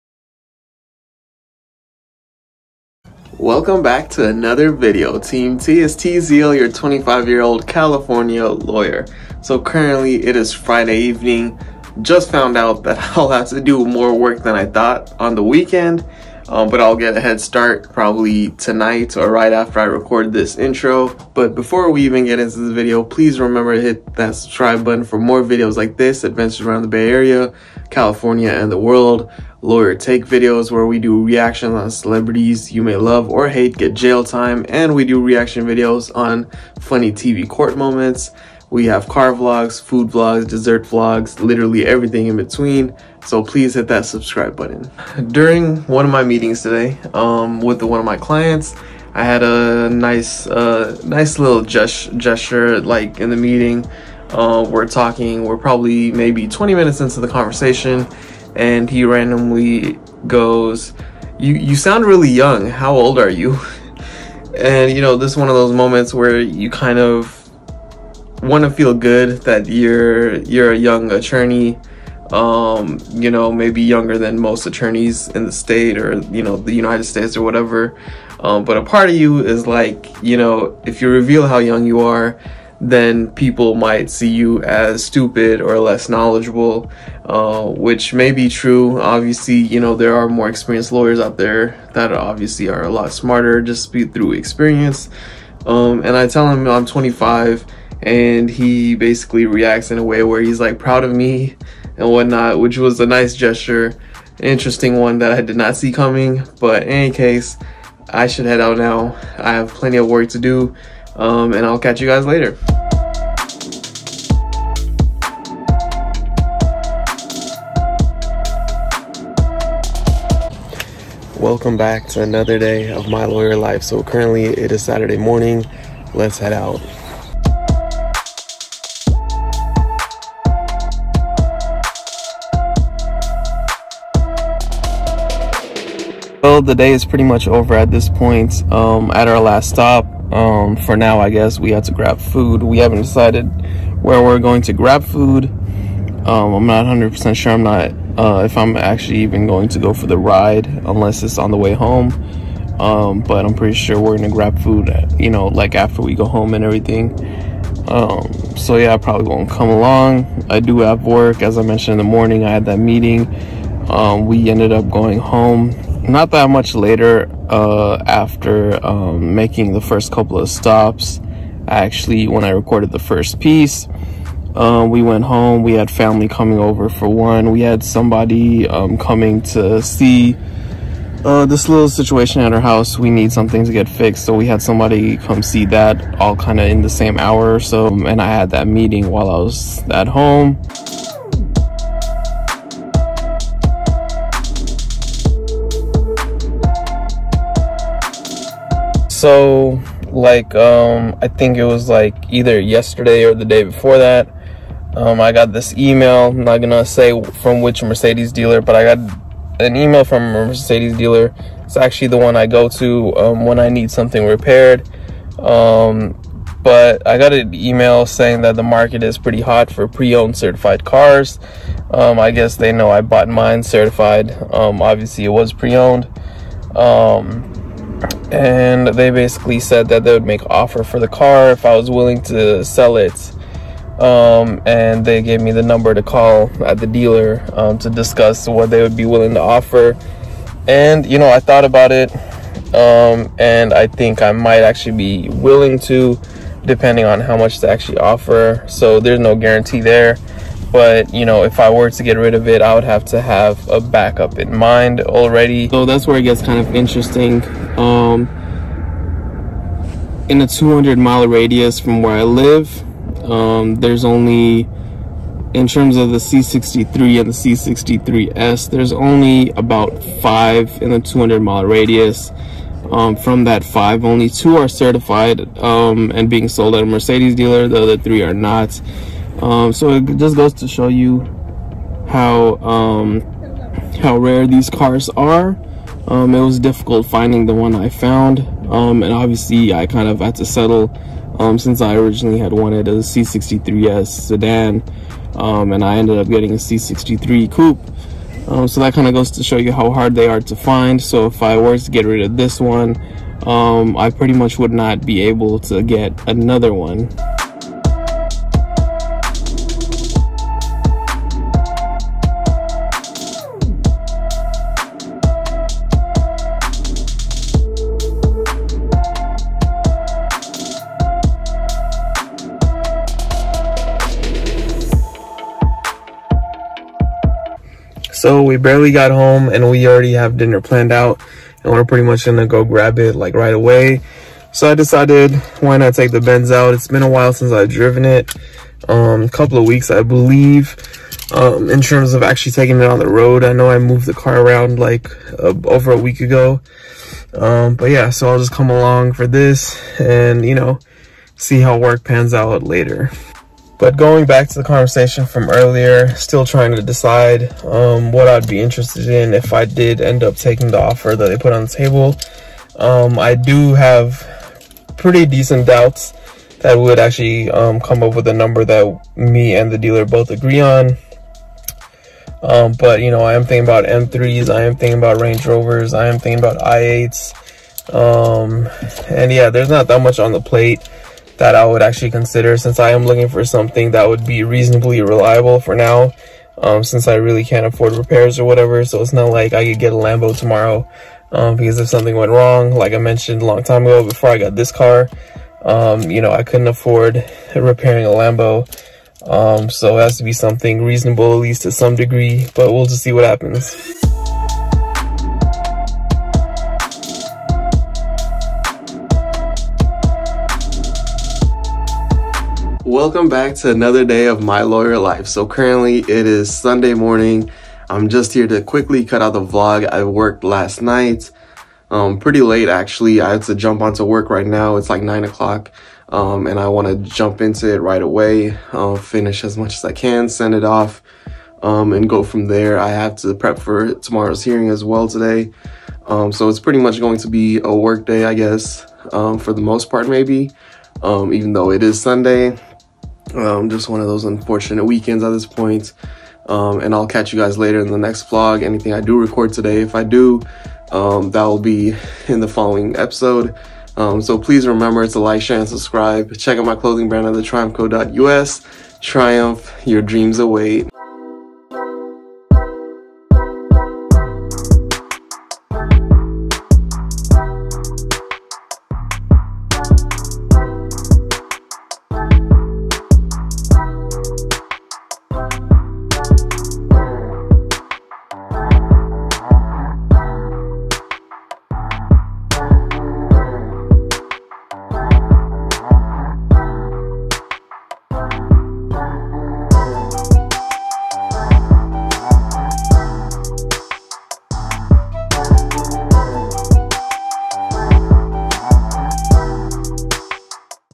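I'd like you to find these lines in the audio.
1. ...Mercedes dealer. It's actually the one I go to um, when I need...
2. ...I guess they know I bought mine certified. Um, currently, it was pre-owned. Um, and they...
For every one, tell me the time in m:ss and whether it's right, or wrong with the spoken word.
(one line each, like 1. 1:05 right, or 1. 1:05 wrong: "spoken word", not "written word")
1. 3:30 right
2. 3:42 wrong: "obviously", not "currently".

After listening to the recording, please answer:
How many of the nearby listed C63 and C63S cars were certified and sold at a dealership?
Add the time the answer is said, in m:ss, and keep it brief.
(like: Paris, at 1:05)
2, at 4:34.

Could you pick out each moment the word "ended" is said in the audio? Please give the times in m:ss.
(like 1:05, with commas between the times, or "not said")
2:44, 4:55.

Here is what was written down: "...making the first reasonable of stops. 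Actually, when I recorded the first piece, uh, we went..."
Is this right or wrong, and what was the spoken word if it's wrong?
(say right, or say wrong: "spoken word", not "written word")
wrong: "couple", not "reasonable".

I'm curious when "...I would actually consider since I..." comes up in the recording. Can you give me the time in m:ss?
6:21.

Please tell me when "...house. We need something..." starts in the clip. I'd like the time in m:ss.
3:02.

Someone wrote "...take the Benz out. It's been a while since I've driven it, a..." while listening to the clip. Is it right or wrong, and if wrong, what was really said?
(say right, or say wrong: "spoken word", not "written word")
right.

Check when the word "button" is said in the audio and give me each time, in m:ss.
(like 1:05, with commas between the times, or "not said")
0:24, 0:44.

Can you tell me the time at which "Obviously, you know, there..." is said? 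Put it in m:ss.
1:28.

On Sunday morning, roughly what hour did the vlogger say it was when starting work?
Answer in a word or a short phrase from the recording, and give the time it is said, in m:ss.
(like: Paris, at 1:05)
9 o'clock, at 7:05.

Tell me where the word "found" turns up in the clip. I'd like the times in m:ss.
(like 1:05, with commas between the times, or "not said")
0:12, 4:47.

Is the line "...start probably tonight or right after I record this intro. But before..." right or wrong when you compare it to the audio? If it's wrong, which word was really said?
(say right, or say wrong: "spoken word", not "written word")
right.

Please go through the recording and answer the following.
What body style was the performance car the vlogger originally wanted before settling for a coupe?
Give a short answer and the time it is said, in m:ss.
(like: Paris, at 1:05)
C63S sedan, at 4:52.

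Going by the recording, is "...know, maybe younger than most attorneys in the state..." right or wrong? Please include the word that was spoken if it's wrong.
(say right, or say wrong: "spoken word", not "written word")
right.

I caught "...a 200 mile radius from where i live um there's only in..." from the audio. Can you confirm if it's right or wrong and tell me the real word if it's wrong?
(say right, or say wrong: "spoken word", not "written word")
right.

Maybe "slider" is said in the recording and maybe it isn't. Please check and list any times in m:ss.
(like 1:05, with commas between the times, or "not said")
not said.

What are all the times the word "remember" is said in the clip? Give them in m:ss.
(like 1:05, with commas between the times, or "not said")
0:23, 7:34.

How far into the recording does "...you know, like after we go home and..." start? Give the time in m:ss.
2:35.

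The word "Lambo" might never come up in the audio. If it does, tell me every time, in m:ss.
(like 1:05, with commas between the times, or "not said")
6:29, 6:38.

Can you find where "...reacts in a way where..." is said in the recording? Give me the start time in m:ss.
1:39.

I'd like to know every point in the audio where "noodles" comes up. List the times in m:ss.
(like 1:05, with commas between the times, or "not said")
not said.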